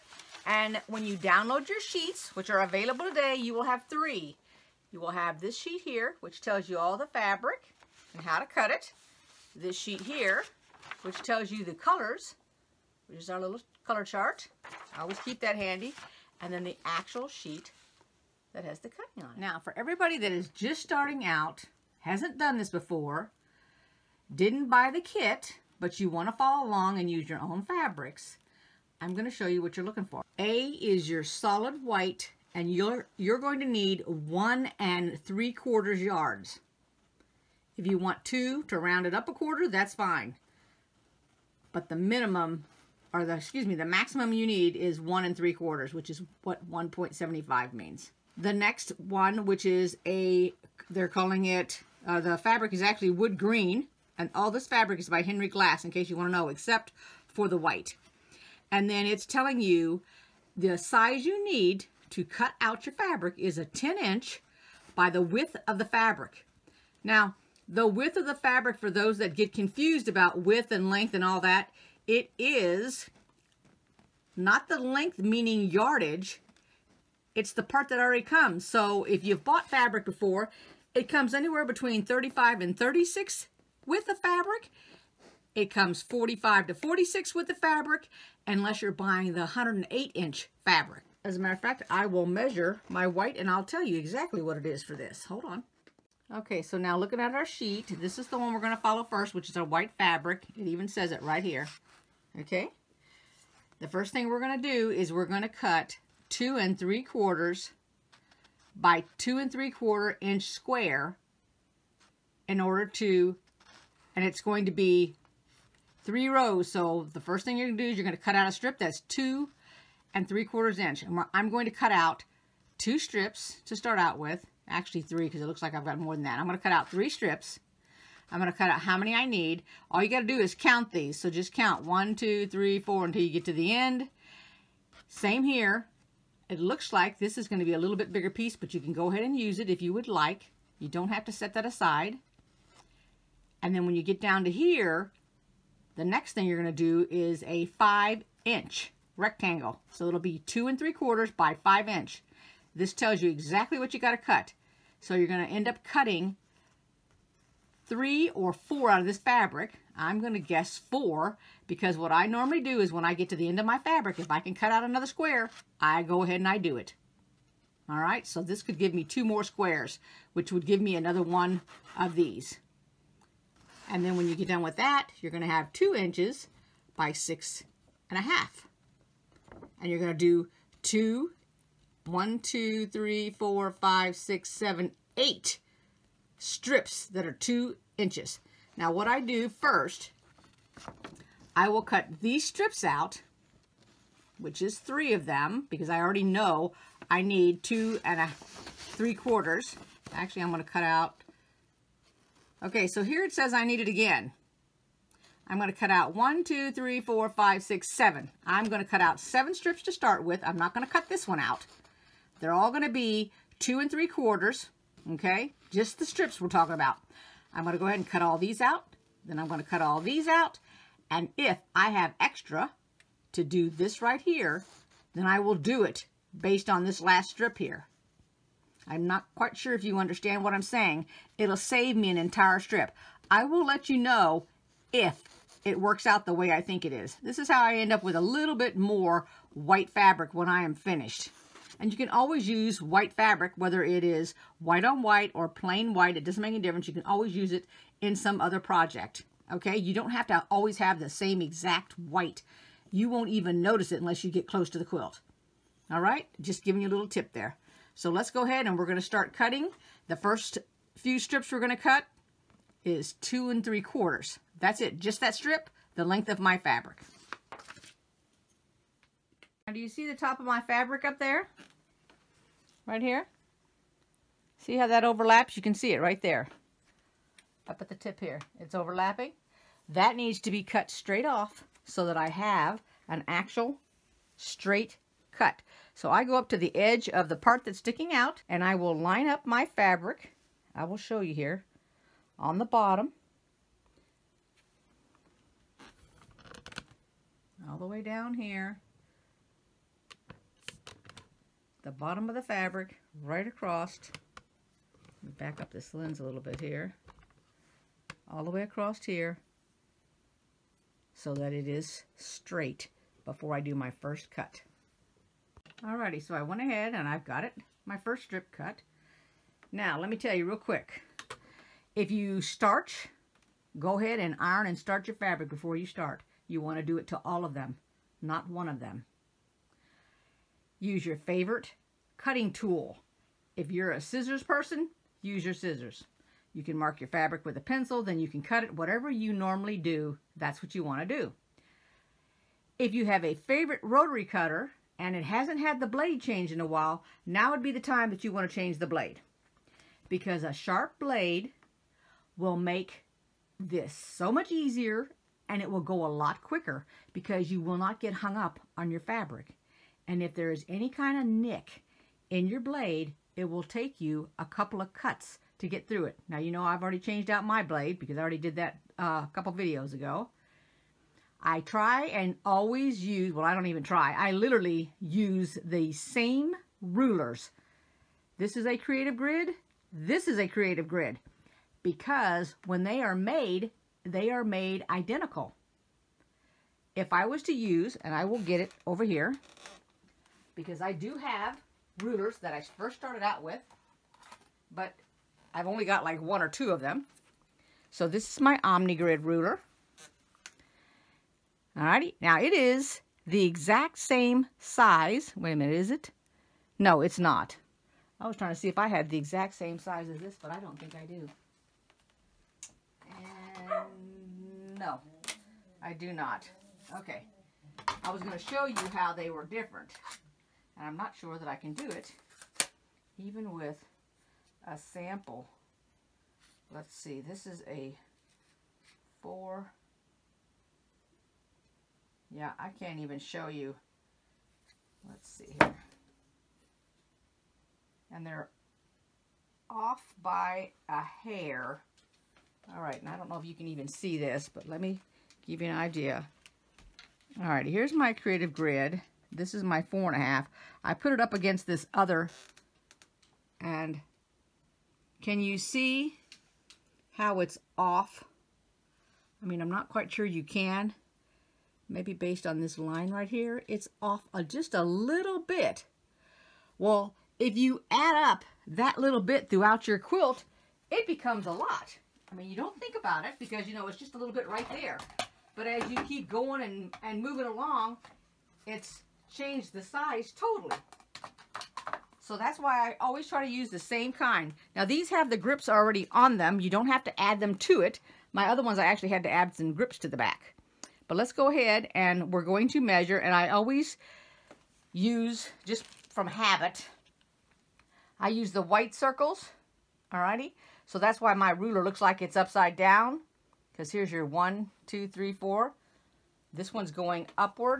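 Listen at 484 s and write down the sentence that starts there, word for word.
Now these have the grips already on them.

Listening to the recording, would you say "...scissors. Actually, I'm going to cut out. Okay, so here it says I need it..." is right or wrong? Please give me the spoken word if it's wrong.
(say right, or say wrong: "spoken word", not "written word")
wrong: "quarters", not "scissors".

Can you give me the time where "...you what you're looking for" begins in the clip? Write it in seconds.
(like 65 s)
29 s.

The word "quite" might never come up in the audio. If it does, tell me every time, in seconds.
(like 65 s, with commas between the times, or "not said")
229 s, 459 s.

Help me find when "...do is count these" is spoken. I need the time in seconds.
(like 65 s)
130 s.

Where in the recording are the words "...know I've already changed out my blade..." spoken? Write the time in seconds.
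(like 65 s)
366 s.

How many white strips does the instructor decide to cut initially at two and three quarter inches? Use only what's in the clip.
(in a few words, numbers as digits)
7.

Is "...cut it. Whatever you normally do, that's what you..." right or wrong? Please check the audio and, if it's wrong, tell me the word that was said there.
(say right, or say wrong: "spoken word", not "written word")
right.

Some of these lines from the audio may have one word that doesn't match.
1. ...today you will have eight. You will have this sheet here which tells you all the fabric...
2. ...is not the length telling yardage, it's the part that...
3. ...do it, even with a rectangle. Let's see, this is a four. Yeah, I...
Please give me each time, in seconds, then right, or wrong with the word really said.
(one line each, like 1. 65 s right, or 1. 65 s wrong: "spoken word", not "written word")
1. 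3 s wrong: "three", not "eight"
2. 72 s wrong: "meaning", not "telling"
3. 421 s wrong: "sample", not "rectangle".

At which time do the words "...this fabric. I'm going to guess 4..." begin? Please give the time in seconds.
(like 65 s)
159 s.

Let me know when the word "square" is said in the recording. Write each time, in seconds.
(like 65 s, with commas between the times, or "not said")
110 s, 165 s, 169 s.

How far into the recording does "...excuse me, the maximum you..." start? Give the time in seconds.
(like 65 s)
43 s.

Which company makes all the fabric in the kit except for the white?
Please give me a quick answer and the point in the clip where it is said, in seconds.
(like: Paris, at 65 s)
Henry Glass, at 55 s.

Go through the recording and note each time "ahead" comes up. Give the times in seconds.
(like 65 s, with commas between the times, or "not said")
139 s, 166 s, 217 s, 258 s, 316 s, 323 s, 491 s.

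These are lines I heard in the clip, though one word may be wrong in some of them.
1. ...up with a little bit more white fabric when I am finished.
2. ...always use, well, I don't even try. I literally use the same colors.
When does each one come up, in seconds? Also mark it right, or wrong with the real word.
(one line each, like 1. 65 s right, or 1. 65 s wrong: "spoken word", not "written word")
1. 237 s right
2. 372 s wrong: "rulers", not "colors".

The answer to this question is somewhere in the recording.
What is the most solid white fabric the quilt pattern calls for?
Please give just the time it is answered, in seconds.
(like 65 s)
34 s.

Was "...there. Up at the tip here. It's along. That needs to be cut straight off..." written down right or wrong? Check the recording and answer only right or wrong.
wrong.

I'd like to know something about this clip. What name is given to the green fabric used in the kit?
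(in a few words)
wood green.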